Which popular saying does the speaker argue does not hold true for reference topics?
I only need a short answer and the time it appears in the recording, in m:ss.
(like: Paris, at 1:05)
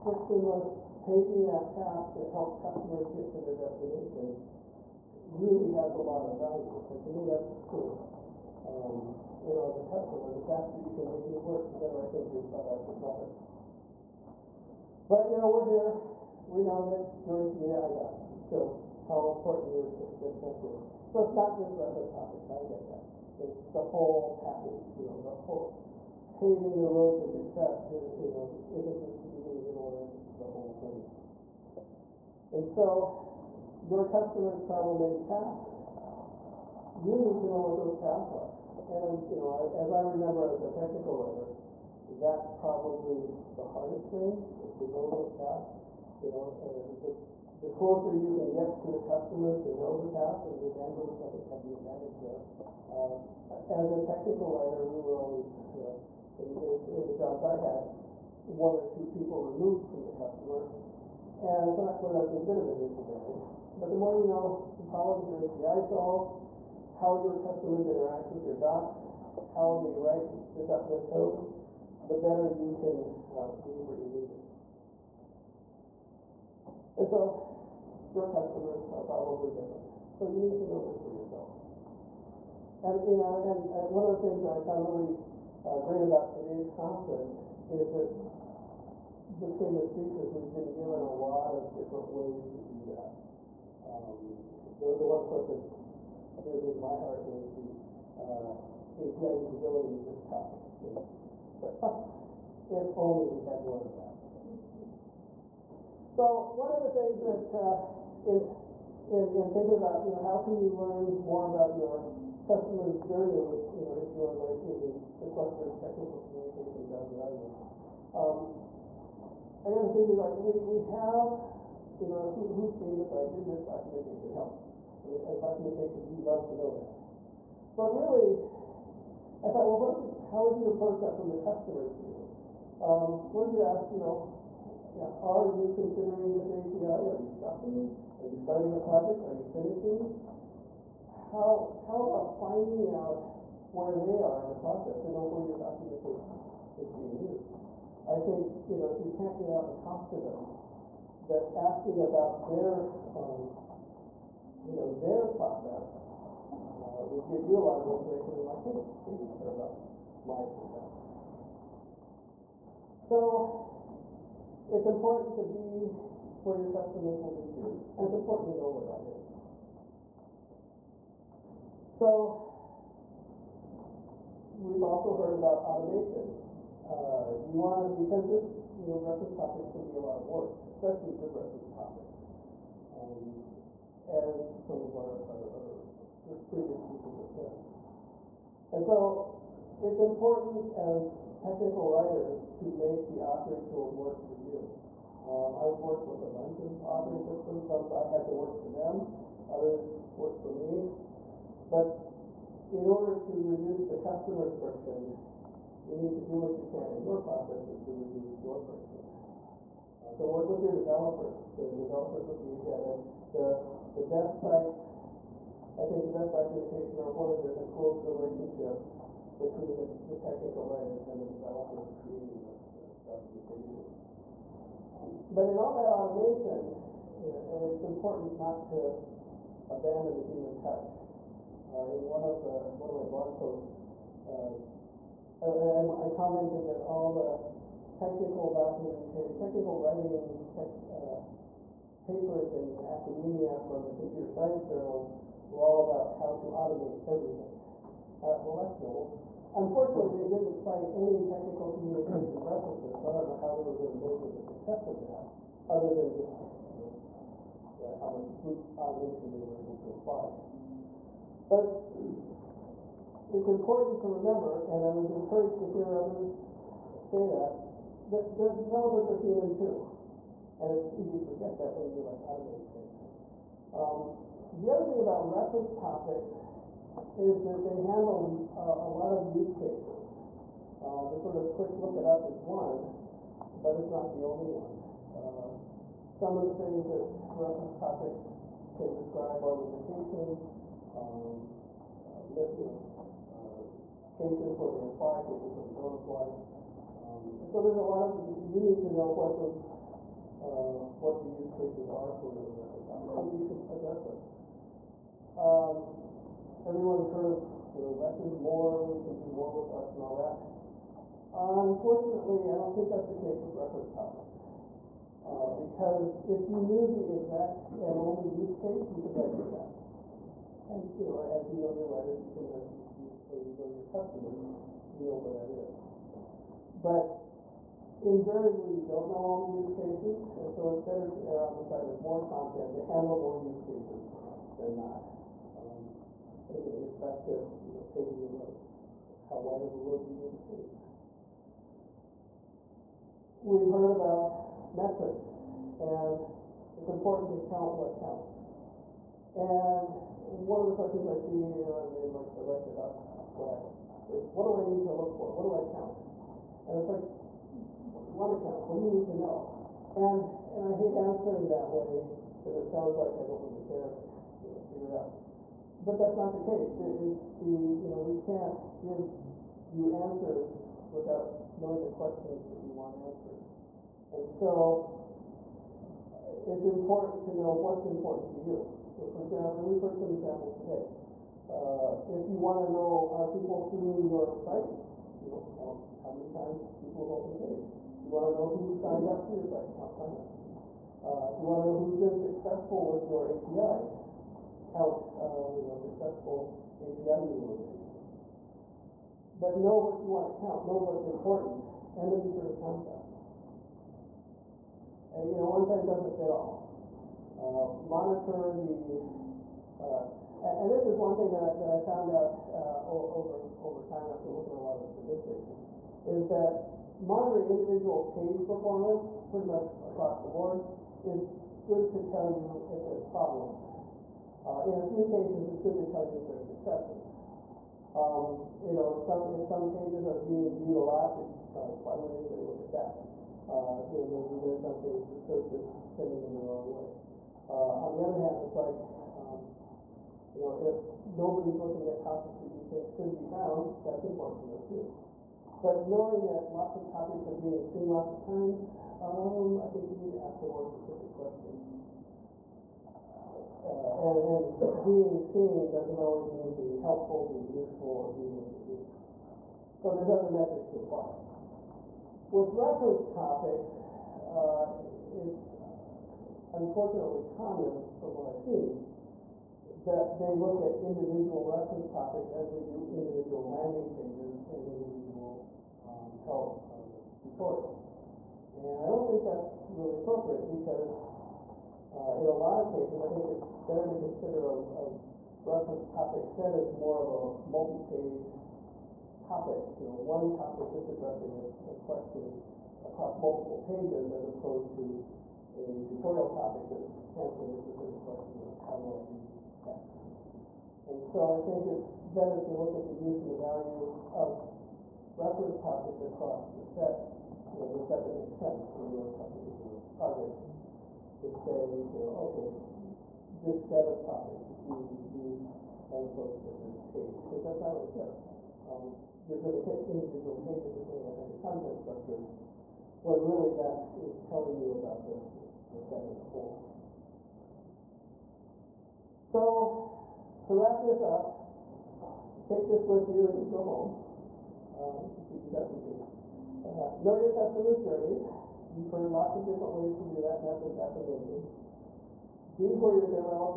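less is more, at 5:07.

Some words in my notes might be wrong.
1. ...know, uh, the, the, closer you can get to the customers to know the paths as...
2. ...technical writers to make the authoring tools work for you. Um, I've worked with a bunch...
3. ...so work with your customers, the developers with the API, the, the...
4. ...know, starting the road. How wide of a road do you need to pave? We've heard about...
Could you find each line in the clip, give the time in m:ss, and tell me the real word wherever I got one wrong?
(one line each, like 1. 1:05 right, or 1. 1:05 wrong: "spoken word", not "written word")
1. 0:46 right
2. 3:11 right
3. 3:30 wrong: "developers", not "customers"
4. 5:37 wrong: "paving", not "starting".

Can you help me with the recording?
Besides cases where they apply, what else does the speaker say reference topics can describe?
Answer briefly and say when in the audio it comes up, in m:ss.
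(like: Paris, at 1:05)
limitations, at 4:49.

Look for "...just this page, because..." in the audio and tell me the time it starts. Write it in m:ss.
8:36.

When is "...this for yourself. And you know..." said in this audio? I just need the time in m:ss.
1:20.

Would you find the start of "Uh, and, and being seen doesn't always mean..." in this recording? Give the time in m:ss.
7:33.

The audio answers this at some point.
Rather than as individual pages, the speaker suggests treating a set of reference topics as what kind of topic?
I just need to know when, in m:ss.
8:07.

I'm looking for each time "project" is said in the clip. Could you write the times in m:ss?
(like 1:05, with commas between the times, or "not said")
2:18, 8:29.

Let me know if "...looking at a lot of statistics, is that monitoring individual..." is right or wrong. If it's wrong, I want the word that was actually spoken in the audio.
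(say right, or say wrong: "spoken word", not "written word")
right.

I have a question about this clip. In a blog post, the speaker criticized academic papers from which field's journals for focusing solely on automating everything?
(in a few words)
computer science.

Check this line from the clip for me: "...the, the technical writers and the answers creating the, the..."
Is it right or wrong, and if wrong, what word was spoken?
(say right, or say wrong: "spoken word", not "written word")
wrong: "developers", not "answers".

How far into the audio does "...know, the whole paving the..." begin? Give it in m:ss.
0:25.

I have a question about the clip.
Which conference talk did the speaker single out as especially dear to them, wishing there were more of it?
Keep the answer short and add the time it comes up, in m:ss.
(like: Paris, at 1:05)
API usability, at 1:38.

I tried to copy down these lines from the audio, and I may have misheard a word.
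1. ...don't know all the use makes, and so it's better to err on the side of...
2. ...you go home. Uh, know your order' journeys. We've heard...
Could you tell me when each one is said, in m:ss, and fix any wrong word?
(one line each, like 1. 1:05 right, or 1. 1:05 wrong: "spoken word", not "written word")
1. 5:28 wrong: "cases", not "makes"
2. 8:53 wrong: "customers", not "order".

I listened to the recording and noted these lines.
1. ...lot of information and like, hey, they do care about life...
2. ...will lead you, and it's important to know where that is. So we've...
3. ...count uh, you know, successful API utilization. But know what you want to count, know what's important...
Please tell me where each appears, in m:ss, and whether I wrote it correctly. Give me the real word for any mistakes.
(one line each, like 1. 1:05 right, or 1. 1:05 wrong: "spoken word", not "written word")
1. 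2:37 right
2. 2:47 right
3. 6:34 right.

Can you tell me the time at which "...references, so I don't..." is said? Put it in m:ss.
4:12.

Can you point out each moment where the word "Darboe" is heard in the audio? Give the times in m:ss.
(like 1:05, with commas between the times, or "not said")
not said.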